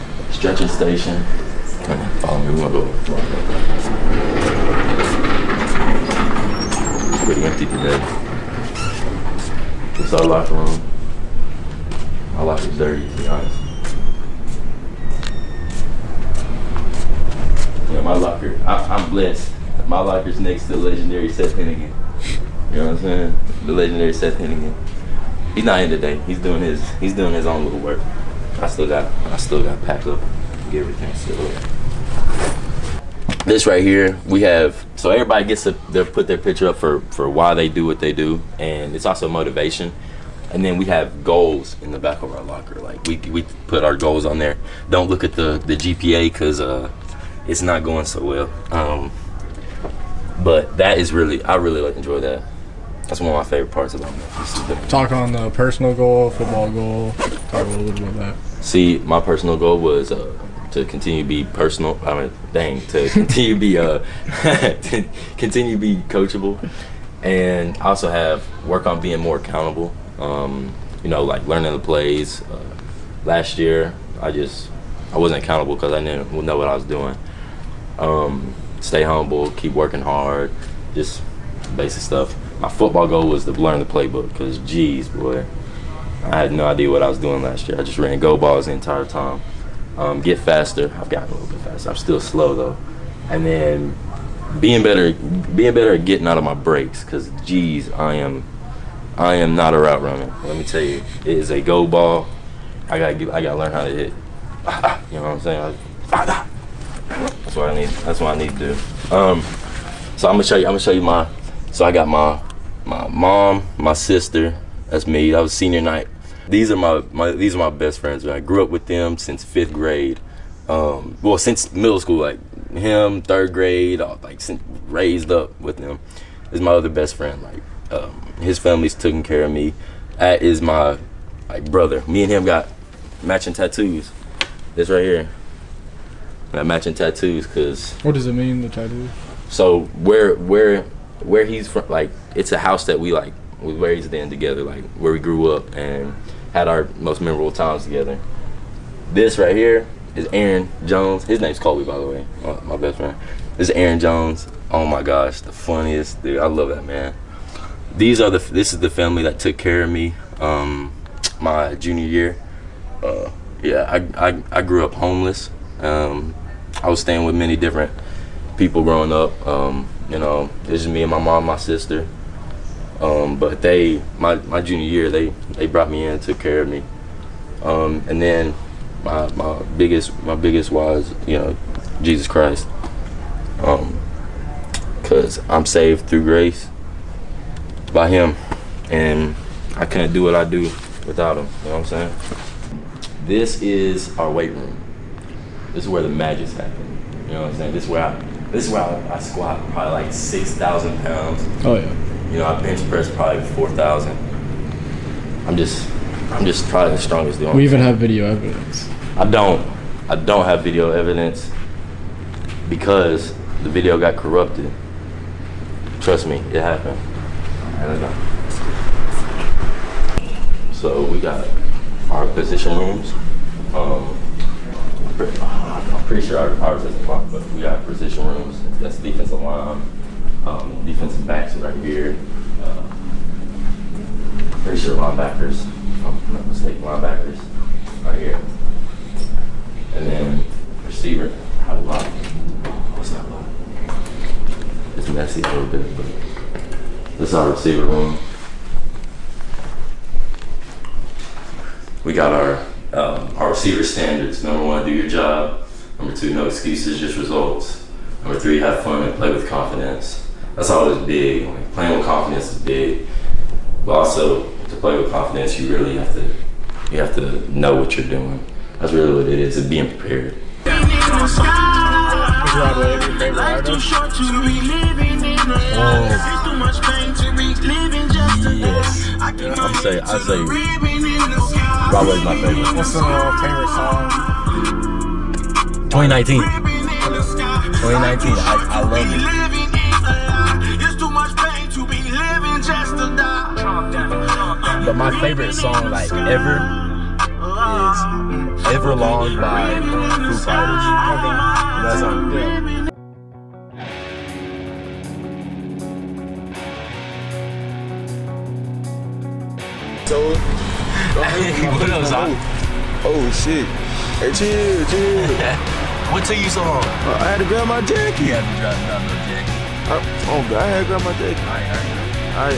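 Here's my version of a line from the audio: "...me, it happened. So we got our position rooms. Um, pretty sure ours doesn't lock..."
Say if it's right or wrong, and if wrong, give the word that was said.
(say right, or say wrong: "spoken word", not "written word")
right.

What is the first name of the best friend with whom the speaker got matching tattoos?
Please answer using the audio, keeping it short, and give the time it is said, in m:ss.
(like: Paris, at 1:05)
Colby, at 2:31.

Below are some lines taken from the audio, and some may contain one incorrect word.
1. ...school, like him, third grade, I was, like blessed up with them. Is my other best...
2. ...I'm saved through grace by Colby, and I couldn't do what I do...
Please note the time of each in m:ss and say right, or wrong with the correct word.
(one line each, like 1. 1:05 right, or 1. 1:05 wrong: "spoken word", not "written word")
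1. 2:01 wrong: "raised", not "blessed"
2. 3:05 wrong: "Him", not "Colby".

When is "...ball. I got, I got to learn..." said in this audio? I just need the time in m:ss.
1:41.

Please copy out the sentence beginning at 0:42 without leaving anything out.
Like we, we put our goals on there.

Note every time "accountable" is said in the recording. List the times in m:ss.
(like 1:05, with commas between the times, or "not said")
1:09, 1:15.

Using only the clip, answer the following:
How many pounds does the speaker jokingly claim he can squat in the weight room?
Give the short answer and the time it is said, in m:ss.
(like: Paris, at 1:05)
6000, at 3:20.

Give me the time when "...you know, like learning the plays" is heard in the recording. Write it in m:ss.
1:11.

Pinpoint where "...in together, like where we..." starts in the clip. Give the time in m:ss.
2:24.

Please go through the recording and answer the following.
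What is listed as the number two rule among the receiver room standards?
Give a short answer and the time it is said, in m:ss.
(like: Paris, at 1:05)
No excuses, just results, at 4:16.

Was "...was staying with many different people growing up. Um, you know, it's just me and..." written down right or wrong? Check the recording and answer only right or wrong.
right.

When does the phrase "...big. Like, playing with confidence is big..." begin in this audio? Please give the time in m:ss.
4:21.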